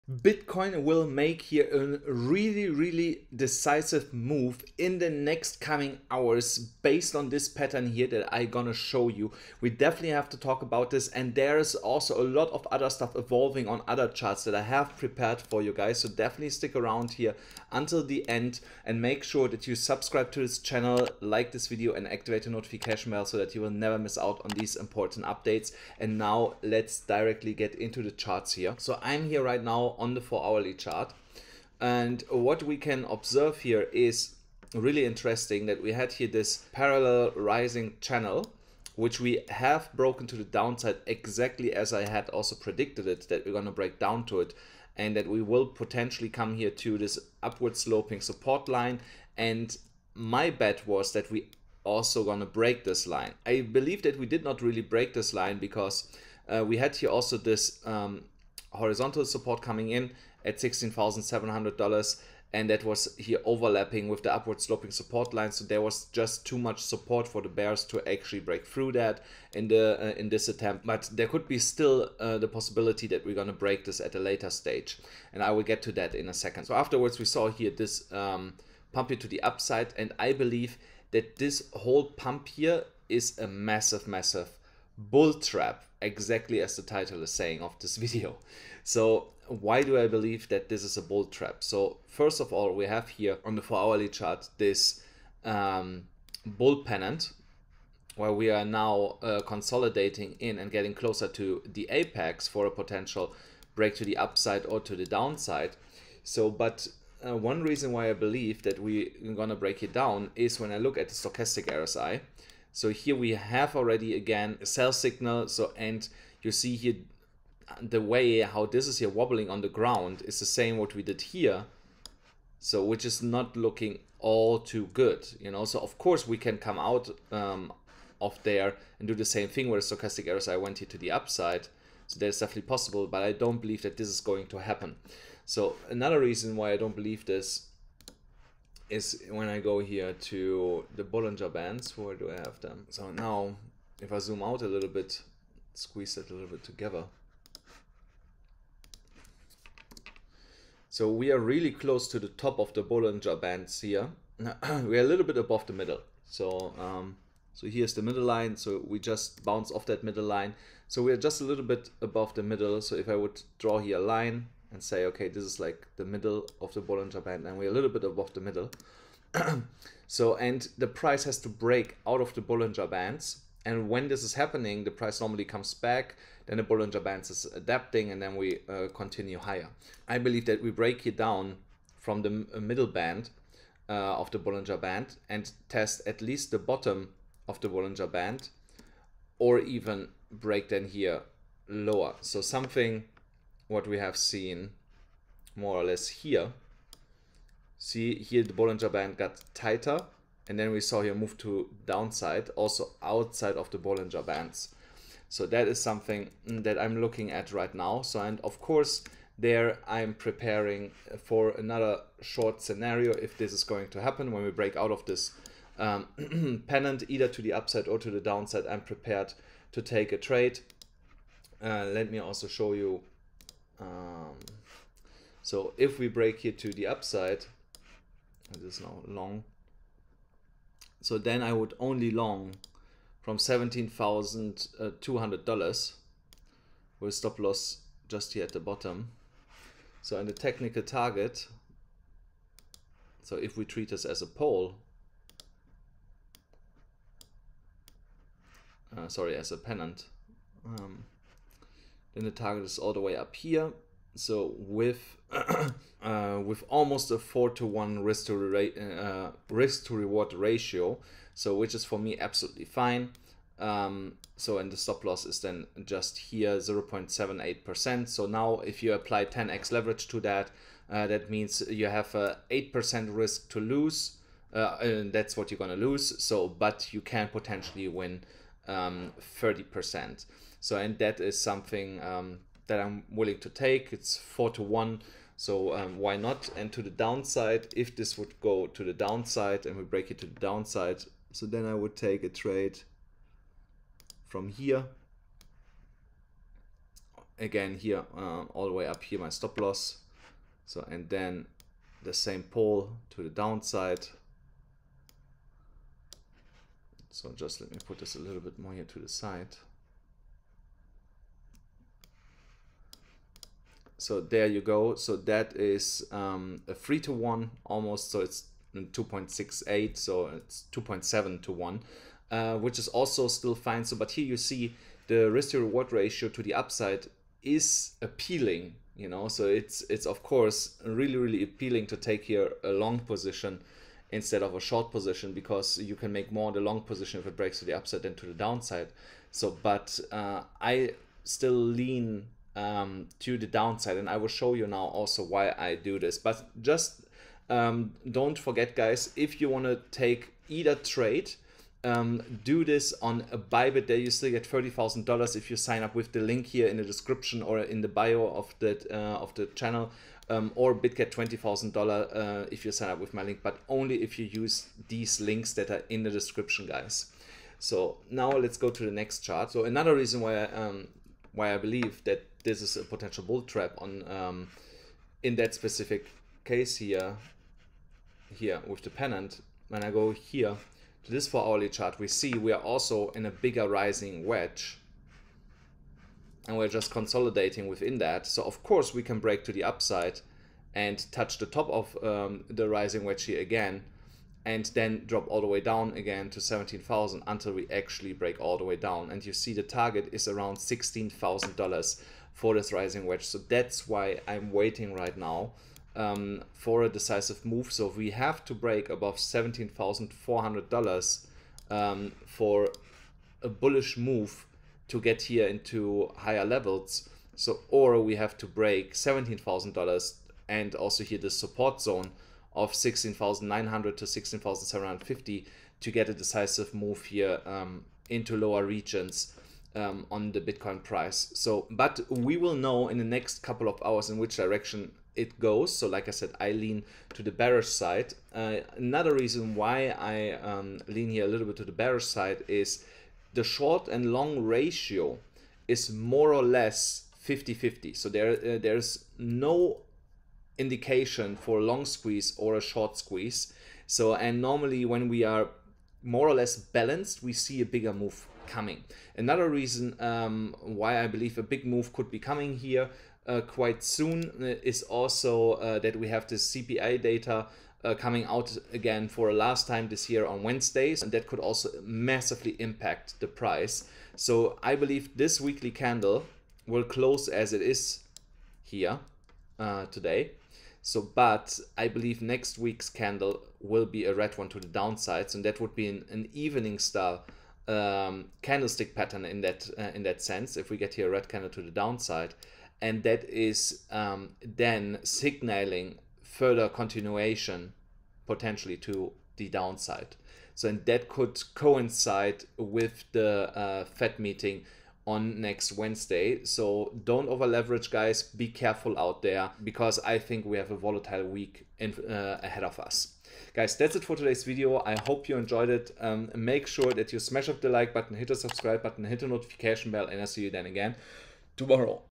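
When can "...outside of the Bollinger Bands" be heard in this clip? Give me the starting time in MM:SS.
03:23.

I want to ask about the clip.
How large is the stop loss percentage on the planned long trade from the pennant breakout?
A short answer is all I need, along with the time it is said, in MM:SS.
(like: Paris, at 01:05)
0.78%, at 04:26.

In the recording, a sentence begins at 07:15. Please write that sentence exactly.
So, like I said, I lean to the bearish side.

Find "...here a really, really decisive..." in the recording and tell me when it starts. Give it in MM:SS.
00:01.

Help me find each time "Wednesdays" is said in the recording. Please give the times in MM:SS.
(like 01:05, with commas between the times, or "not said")
07:50, 08:25.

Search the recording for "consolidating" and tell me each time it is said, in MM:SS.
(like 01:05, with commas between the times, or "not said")
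01:39, 06:26.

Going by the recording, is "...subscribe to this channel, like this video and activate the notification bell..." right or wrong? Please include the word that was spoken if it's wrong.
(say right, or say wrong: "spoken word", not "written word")
right.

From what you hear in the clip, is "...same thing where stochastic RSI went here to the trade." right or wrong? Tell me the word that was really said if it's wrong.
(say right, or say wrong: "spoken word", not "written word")
wrong: "upside", not "trade".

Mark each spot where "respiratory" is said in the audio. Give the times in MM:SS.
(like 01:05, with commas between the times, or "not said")
not said.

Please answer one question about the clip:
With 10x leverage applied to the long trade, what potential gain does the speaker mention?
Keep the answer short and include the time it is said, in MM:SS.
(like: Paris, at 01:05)
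30%, at 04:39.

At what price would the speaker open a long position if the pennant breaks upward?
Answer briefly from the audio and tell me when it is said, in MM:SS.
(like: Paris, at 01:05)
$17,200, at 03:53.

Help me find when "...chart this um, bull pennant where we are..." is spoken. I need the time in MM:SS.
01:34.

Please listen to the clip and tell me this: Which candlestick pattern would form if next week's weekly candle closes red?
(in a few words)
evening star.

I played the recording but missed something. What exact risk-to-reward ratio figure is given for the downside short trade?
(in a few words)
2.68.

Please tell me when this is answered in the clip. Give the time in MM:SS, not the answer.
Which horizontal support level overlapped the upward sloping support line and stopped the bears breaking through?
01:00.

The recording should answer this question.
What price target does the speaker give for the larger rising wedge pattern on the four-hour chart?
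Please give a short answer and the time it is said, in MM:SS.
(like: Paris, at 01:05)
$16,000, at 06:40.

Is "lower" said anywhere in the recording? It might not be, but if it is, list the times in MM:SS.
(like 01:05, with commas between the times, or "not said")
03:11, 07:08.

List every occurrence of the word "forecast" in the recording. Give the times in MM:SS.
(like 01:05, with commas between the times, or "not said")
not said.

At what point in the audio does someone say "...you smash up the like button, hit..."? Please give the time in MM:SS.
08:37.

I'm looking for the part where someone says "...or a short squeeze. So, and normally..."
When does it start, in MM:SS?
07:32.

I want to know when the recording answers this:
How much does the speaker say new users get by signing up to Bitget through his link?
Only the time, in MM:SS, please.
06:01.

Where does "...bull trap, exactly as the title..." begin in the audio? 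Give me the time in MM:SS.
01:25.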